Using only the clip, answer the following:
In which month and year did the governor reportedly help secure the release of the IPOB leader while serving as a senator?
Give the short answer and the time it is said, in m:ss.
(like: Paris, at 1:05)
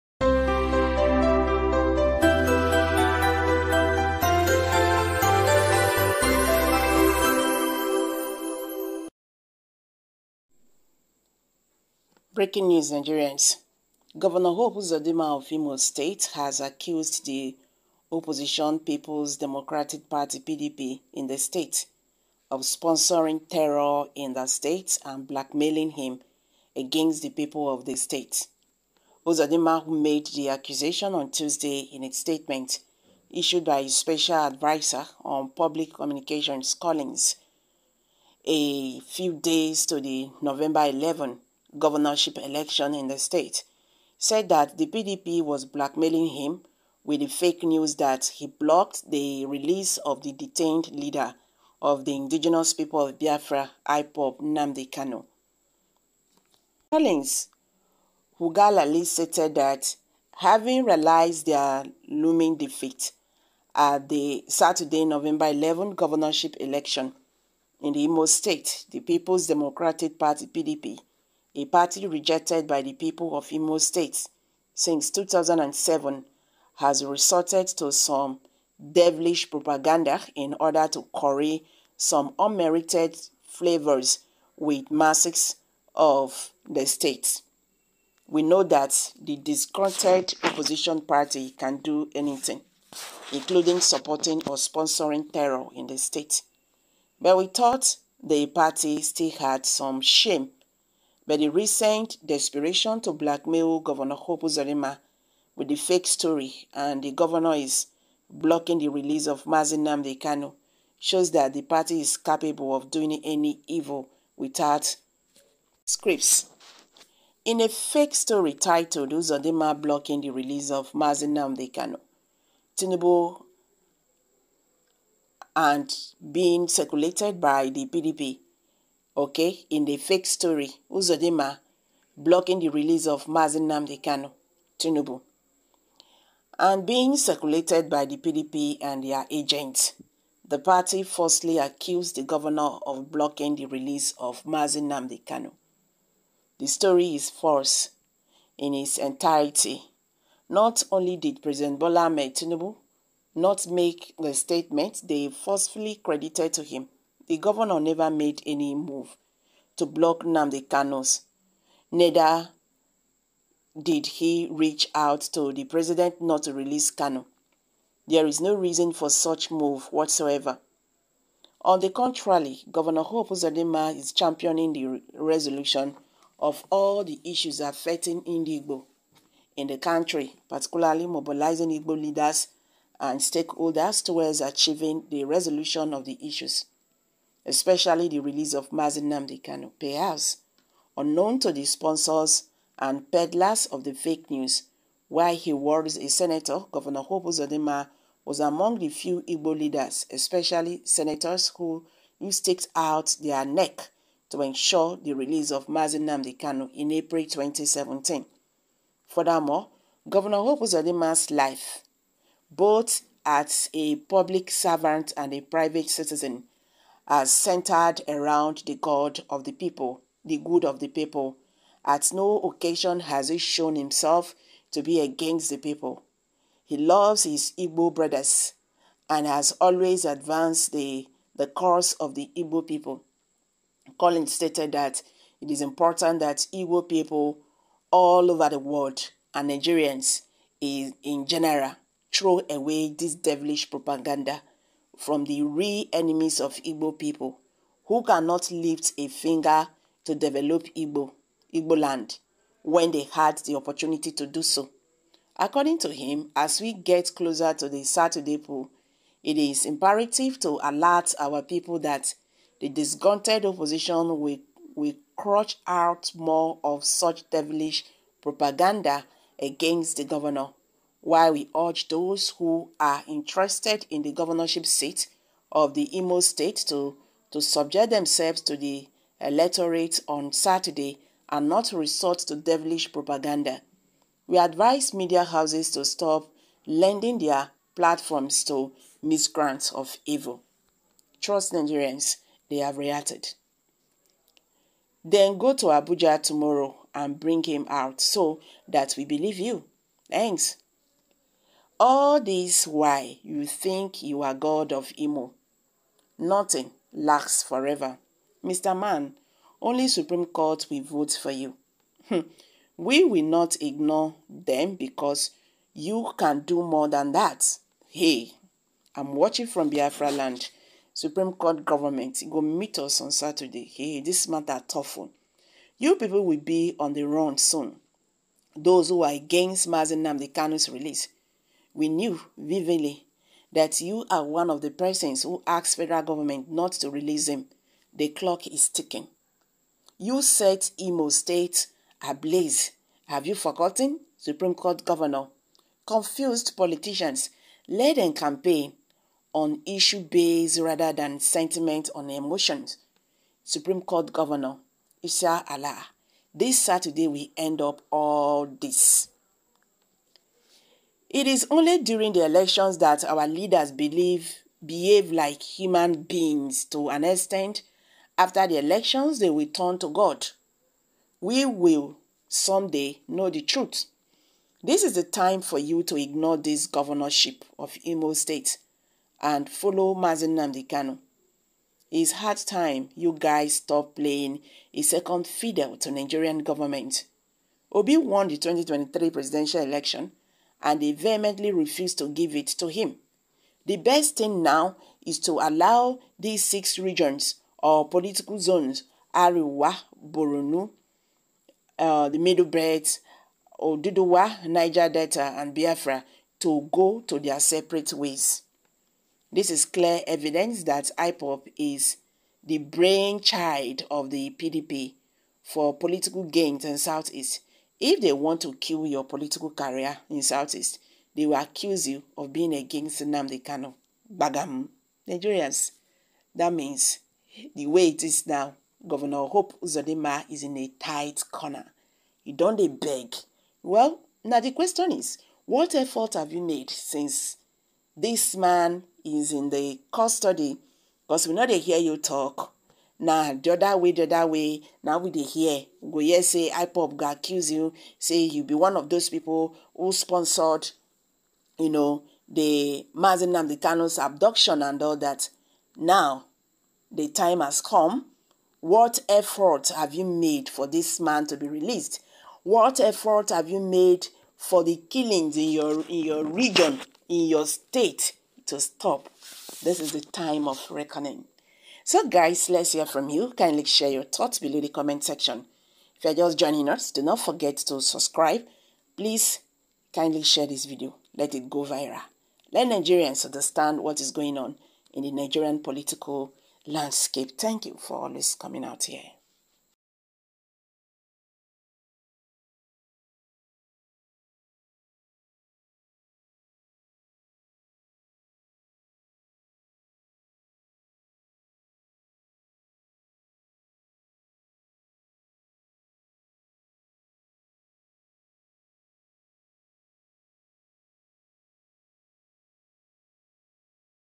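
April 2017, at 3:26.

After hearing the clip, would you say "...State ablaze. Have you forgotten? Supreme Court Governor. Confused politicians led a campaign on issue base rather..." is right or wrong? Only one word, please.
right.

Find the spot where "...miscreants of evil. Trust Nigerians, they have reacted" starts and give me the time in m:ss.
4:49.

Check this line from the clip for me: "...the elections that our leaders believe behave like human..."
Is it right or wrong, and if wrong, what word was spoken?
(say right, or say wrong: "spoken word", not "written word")
right.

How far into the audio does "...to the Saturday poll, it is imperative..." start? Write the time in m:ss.
4:17.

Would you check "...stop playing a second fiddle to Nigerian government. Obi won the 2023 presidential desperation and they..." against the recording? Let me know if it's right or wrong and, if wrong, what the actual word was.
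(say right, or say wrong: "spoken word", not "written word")
wrong: "election", not "desperation".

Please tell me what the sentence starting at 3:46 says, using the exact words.
He loves his Igbo brothers and has always advanced the, the cause of the Igbo people.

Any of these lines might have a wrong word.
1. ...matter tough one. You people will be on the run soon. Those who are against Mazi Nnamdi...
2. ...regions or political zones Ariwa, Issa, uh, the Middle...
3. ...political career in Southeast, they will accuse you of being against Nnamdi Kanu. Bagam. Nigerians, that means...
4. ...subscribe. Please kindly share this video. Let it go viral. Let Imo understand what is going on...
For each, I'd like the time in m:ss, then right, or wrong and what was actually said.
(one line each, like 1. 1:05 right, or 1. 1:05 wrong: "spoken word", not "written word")
1. 5:24 right
2. 6:36 wrong: "Boronu", not "Issa"
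3. 6:59 right
4. 7:57 wrong: "Nigerians", not "Imo".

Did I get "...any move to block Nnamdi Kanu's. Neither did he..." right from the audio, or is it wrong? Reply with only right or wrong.
right.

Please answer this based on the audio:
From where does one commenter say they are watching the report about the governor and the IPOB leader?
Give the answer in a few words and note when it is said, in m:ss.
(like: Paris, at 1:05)
Biafra land, at 5:19.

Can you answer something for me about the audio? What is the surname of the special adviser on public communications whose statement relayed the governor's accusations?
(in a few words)
Hugalali.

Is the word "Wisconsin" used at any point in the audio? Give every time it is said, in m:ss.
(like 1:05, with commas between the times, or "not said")
not said.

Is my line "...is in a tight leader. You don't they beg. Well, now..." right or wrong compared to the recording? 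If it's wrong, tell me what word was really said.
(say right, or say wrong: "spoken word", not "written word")
wrong: "corner", not "leader".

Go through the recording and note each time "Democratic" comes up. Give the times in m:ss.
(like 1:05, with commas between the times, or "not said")
0:19, 1:09.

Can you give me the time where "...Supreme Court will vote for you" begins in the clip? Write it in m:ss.
5:09.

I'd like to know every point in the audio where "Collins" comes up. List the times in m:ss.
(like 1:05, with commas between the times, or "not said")
0:36, 0:56, 3:53.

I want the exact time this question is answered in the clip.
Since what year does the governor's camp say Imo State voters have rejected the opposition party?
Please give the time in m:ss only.
1:15.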